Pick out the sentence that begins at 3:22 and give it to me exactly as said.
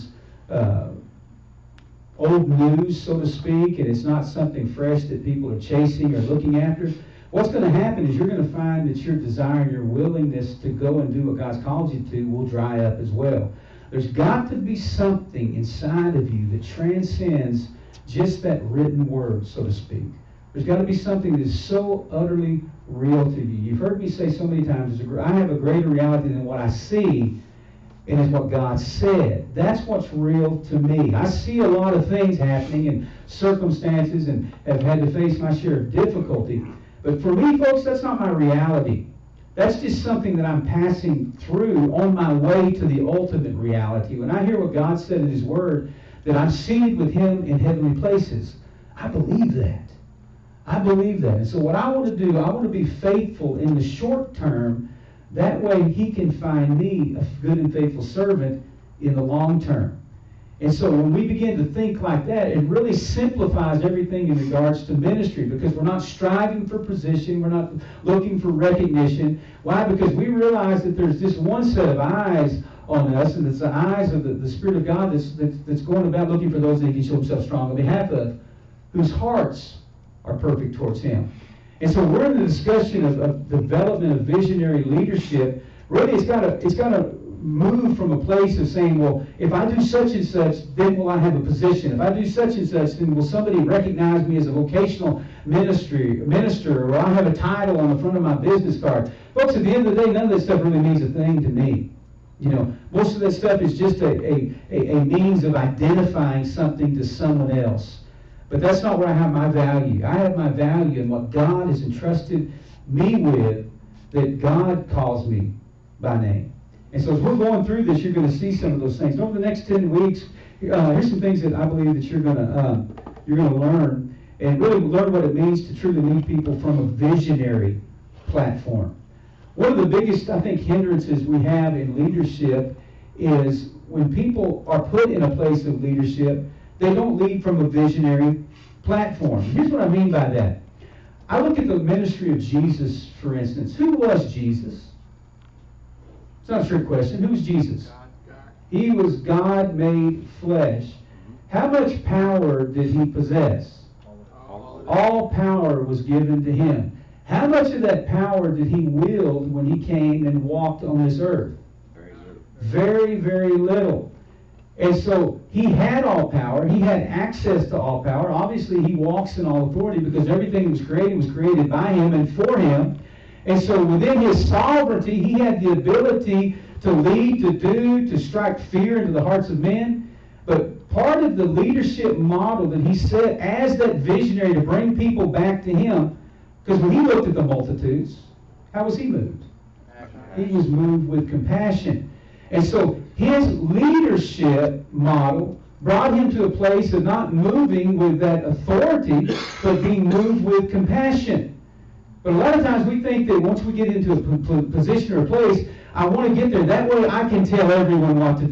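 But a lot of times we think that once we get into a position or a place, I want to get there.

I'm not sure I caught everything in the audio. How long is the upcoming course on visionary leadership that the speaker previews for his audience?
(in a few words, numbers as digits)
10 weeks.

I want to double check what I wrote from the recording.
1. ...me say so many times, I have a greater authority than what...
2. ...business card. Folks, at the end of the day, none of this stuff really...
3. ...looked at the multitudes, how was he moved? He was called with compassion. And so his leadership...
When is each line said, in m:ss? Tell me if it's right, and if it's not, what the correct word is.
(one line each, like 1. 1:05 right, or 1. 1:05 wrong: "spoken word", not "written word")
1. 0:23 wrong: "reality", not "authority"
2. 1:38 right
3. 3:07 wrong: "moved", not "called".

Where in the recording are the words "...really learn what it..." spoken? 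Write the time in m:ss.
2:04.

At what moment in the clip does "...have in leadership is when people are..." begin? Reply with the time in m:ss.
2:11.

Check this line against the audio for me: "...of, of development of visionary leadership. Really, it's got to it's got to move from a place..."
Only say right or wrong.
right.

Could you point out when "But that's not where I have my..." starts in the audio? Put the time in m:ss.
1:48.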